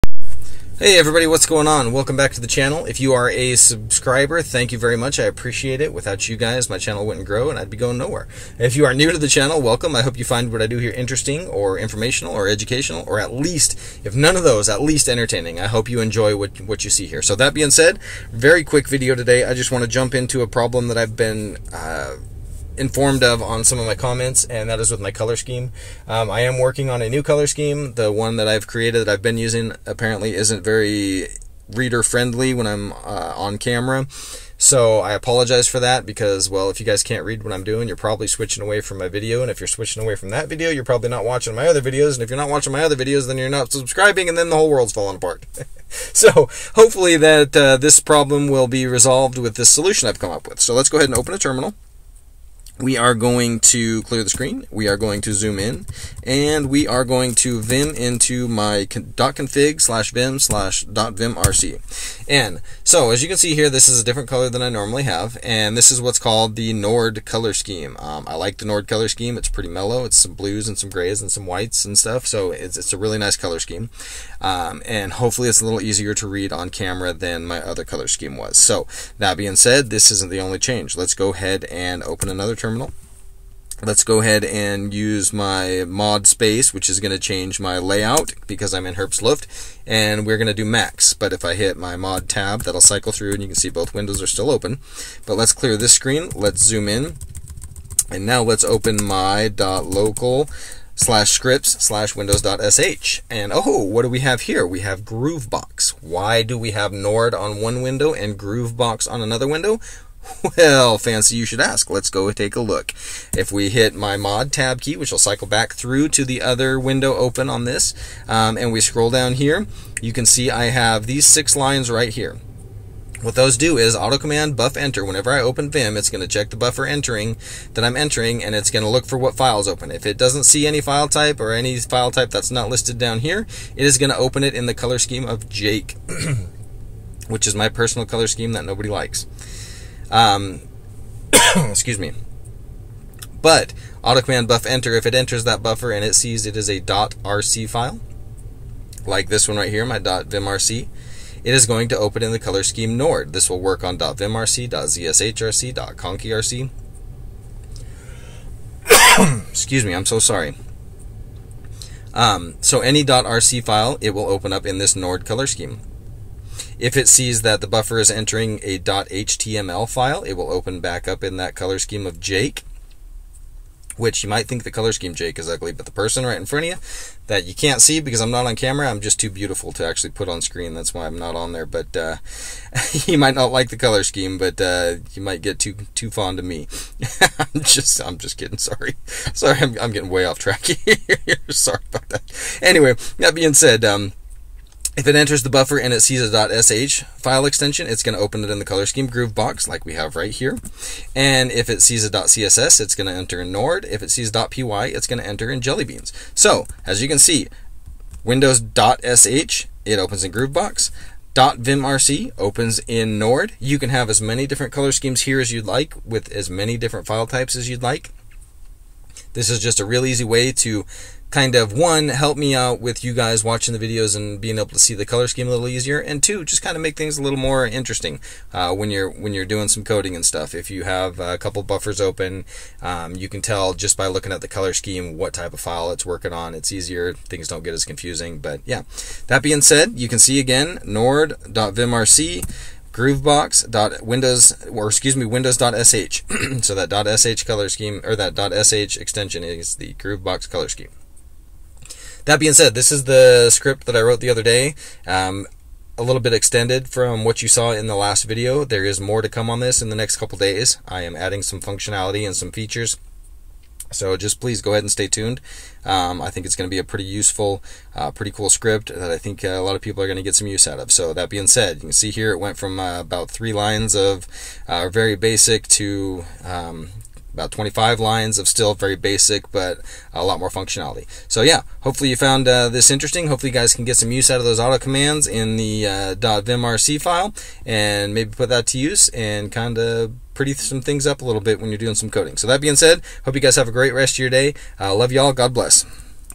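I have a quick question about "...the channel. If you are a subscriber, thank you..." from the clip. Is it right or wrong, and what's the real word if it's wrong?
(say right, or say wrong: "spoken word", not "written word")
right.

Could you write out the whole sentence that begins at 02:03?
What those do is auto command buff enter.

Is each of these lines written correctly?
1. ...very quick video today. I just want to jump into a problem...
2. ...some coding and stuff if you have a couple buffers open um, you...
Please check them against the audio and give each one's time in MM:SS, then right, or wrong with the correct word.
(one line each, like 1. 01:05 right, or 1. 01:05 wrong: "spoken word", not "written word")
1. 00:18 right
2. 03:49 right.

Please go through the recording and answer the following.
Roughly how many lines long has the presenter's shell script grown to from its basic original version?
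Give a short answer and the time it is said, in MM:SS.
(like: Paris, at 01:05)
25, at 04:37.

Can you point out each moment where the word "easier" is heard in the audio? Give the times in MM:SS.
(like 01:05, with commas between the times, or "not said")
01:15, 03:45, 03:56.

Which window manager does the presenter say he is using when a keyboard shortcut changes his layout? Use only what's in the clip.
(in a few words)
Herbstluft.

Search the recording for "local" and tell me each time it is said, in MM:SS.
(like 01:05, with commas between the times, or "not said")
01:39.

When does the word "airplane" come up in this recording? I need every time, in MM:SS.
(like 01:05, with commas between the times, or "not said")
not said.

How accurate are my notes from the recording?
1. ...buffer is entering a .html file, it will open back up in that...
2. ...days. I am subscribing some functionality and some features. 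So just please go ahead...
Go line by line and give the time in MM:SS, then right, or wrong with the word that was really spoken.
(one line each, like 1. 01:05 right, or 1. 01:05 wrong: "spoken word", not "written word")
1. 02:47 right
2. 04:20 wrong: "adding", not "subscribing".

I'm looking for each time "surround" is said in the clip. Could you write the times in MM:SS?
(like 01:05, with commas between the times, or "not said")
not said.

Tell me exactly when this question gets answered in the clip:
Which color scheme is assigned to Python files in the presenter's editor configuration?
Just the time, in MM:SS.
03:25.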